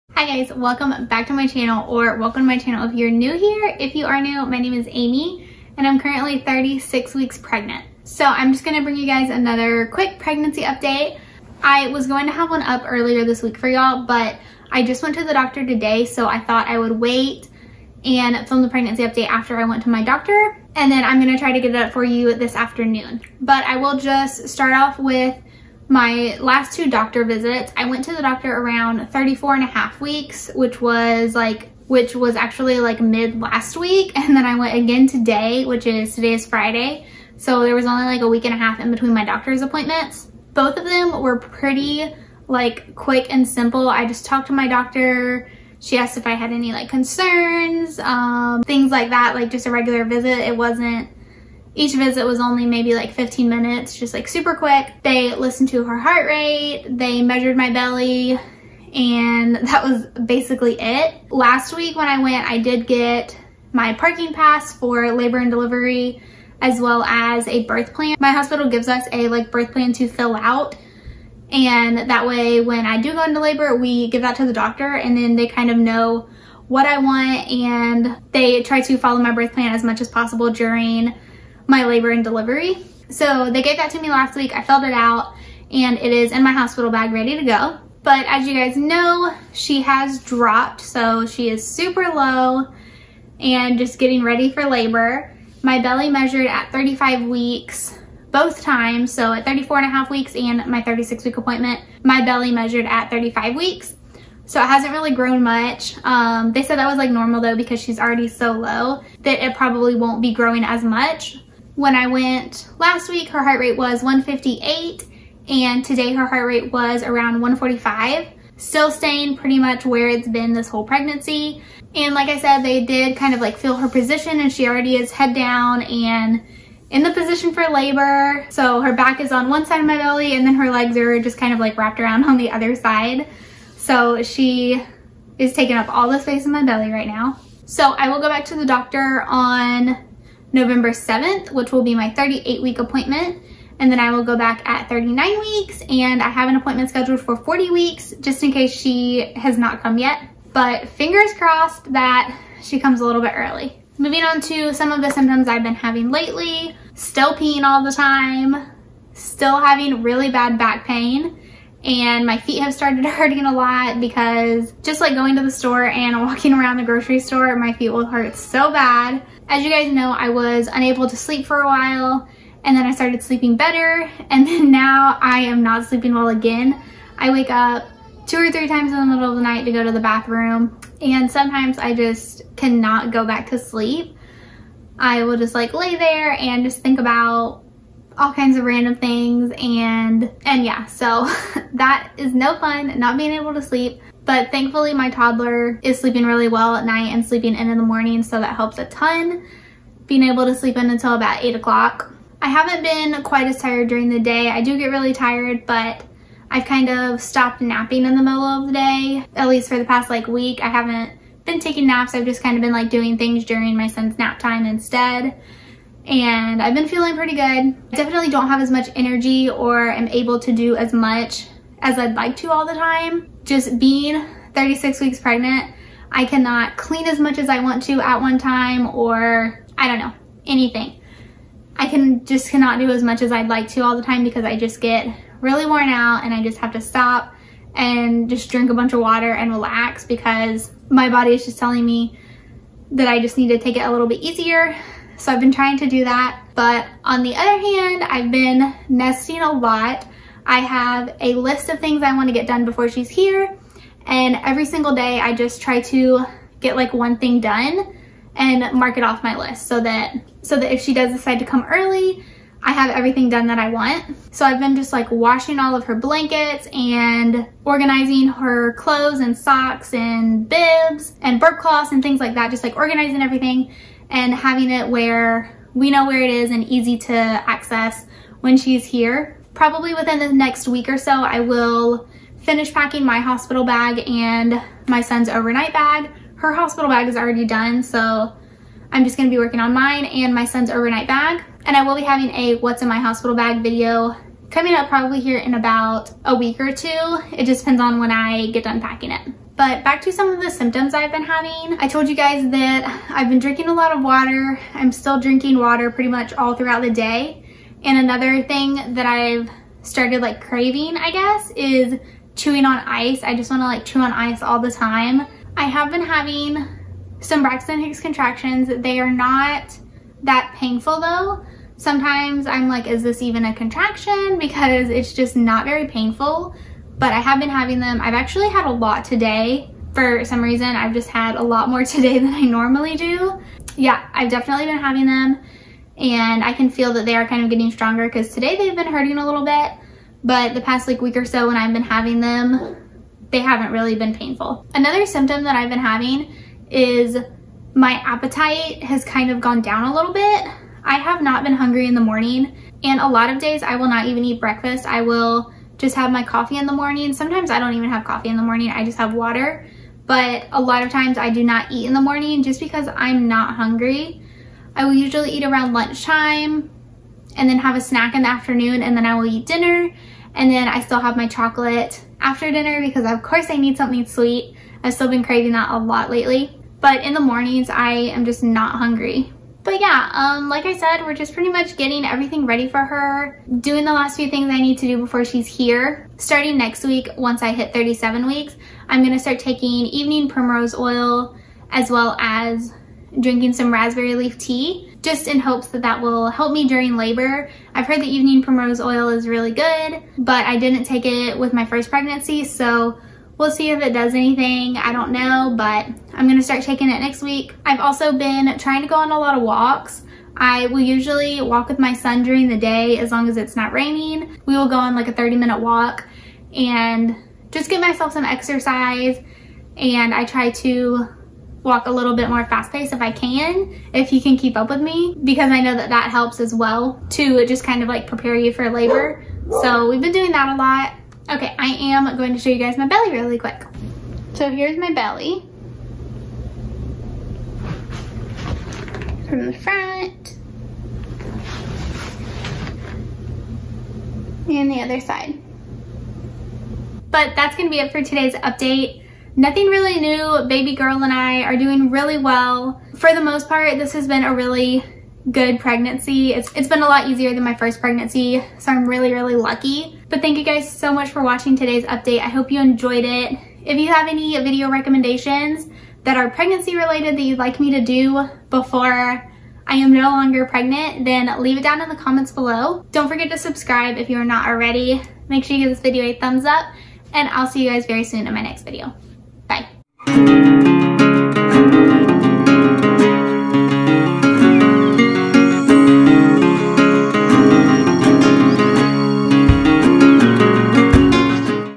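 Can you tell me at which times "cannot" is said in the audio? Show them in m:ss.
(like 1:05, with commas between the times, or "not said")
3:02, 3:46, 3:52.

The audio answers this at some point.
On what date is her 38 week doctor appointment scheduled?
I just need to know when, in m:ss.
2:20.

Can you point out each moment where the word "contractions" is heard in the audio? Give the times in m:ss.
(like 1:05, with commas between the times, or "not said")
5:17, 5:23.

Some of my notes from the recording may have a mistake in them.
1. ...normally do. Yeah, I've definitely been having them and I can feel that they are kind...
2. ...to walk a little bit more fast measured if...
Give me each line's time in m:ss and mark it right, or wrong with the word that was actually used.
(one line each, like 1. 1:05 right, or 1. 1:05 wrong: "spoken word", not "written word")
1. 5:32 right
2. 7:00 wrong: "paced", not "measured".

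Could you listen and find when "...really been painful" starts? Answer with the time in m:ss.
5:43.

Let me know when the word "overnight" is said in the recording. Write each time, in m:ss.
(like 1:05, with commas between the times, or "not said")
4:45, 4:50.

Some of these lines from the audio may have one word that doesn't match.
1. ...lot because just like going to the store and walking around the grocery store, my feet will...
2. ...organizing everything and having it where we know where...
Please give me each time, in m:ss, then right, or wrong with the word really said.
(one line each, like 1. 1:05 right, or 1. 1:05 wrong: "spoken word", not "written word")
1. 2:43 right
2. 4:32 right.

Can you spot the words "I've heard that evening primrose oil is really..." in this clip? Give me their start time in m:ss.
6:37.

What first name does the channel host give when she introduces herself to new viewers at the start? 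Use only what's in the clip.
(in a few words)
Amy.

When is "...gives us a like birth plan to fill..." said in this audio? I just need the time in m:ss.
1:08.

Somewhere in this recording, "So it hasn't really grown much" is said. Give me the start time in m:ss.
1:44.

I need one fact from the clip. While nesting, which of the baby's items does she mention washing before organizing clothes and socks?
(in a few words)
Blankets.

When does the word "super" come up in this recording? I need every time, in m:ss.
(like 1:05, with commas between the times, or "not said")
0:54, 1:31.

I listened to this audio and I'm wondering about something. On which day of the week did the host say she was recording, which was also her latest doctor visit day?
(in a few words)
Friday.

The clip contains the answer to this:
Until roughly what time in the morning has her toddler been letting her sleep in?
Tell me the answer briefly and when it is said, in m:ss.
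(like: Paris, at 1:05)
8 o'clock, at 3:21.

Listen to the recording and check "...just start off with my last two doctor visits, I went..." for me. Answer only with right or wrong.
right.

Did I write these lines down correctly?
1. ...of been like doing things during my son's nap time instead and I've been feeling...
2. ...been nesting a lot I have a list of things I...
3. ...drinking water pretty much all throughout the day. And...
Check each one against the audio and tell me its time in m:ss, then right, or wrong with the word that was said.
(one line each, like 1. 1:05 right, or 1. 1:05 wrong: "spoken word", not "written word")
1. 3:32 right
2. 4:08 right
3. 5:05 right.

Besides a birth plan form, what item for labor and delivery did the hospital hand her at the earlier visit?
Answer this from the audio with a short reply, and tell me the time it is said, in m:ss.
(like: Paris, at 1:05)
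Parking pass, at 1:03.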